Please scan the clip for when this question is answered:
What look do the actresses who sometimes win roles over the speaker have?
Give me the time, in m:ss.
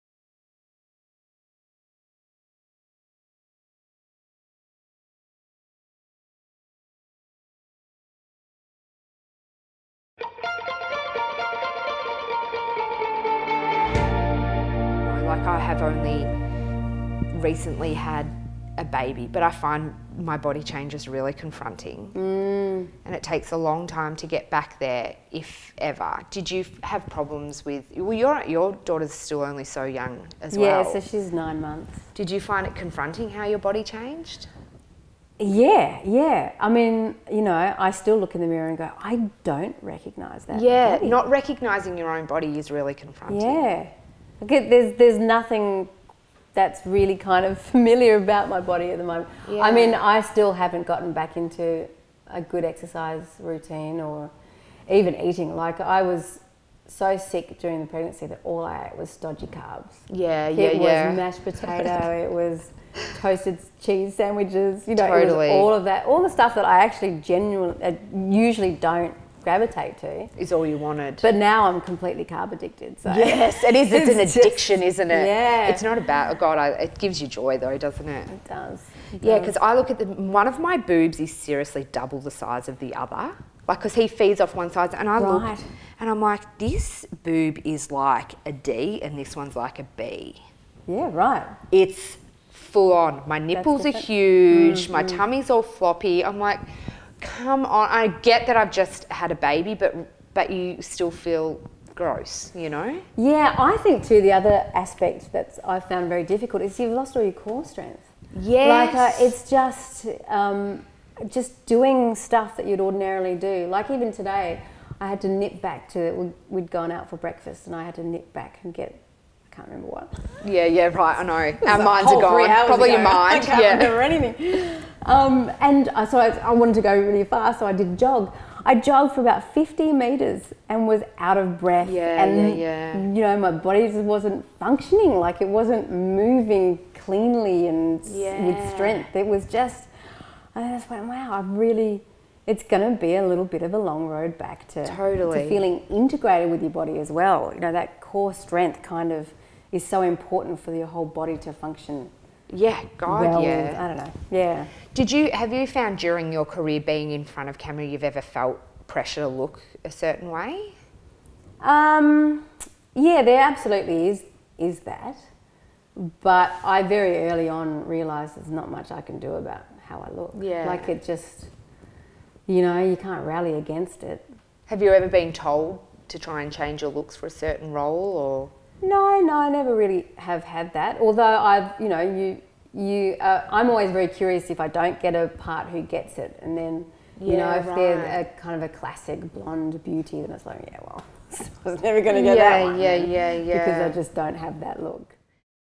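3:08.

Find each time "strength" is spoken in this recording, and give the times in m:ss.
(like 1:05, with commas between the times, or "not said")
1:47, 2:18, 2:28.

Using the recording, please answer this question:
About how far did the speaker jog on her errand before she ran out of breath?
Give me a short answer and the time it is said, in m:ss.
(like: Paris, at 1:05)
50 meters, at 2:09.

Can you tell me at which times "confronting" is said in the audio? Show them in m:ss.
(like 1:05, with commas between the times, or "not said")
0:21, 0:32, 0:42.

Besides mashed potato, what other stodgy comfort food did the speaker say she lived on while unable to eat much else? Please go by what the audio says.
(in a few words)
toasted cheese sandwiches.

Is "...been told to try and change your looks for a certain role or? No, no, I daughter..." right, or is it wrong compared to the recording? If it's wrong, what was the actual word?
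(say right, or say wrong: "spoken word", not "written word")
wrong: "never", not "daughter".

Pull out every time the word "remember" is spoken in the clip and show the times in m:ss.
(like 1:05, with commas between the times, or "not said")
1:59, 2:03.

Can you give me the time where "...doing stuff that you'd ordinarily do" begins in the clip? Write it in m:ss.
1:51.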